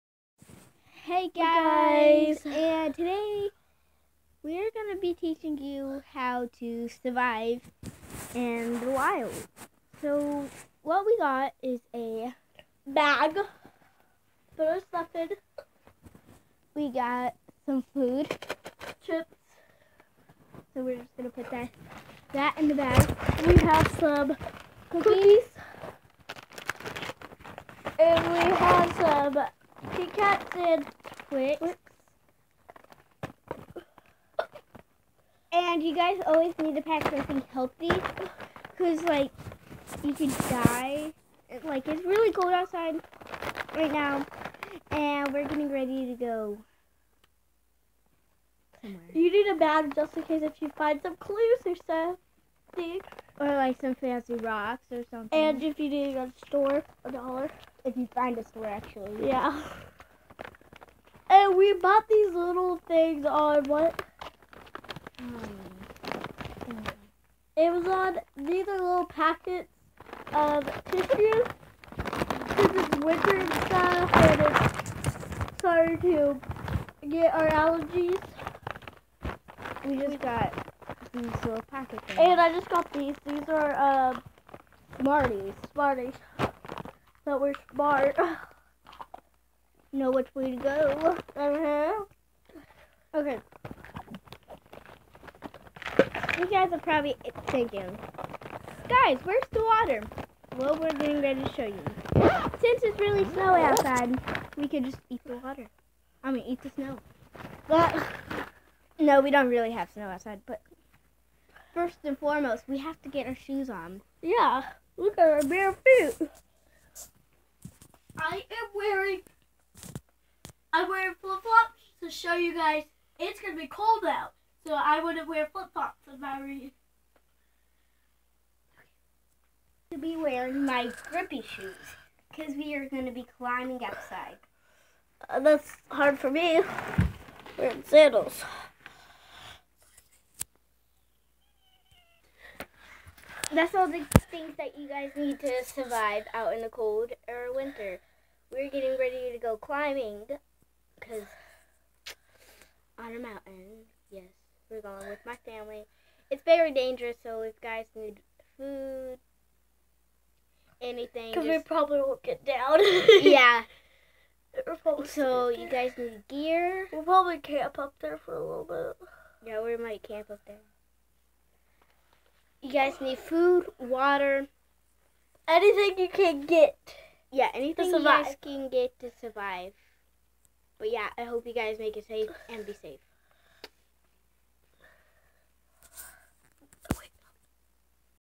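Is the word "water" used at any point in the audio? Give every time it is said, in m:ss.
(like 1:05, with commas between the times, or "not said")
1:39, 1:45, 2:53.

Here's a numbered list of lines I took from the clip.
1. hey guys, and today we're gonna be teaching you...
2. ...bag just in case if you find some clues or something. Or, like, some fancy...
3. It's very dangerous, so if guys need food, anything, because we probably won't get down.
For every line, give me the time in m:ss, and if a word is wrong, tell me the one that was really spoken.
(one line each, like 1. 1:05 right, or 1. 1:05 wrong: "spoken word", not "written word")
1. 0:02 right
2. 0:49 right
3. 2:36 right.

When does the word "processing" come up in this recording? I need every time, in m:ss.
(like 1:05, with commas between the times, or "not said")
not said.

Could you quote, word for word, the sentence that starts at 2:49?
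Yeah, we might camp up there.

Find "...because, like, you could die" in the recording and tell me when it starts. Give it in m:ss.
0:38.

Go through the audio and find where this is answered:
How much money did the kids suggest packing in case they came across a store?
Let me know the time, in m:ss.
0:57.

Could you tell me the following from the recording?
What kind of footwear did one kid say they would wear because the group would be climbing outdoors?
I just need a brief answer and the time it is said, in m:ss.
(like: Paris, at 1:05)
grippy shoes, at 2:11.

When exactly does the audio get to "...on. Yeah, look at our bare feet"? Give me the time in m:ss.
1:53.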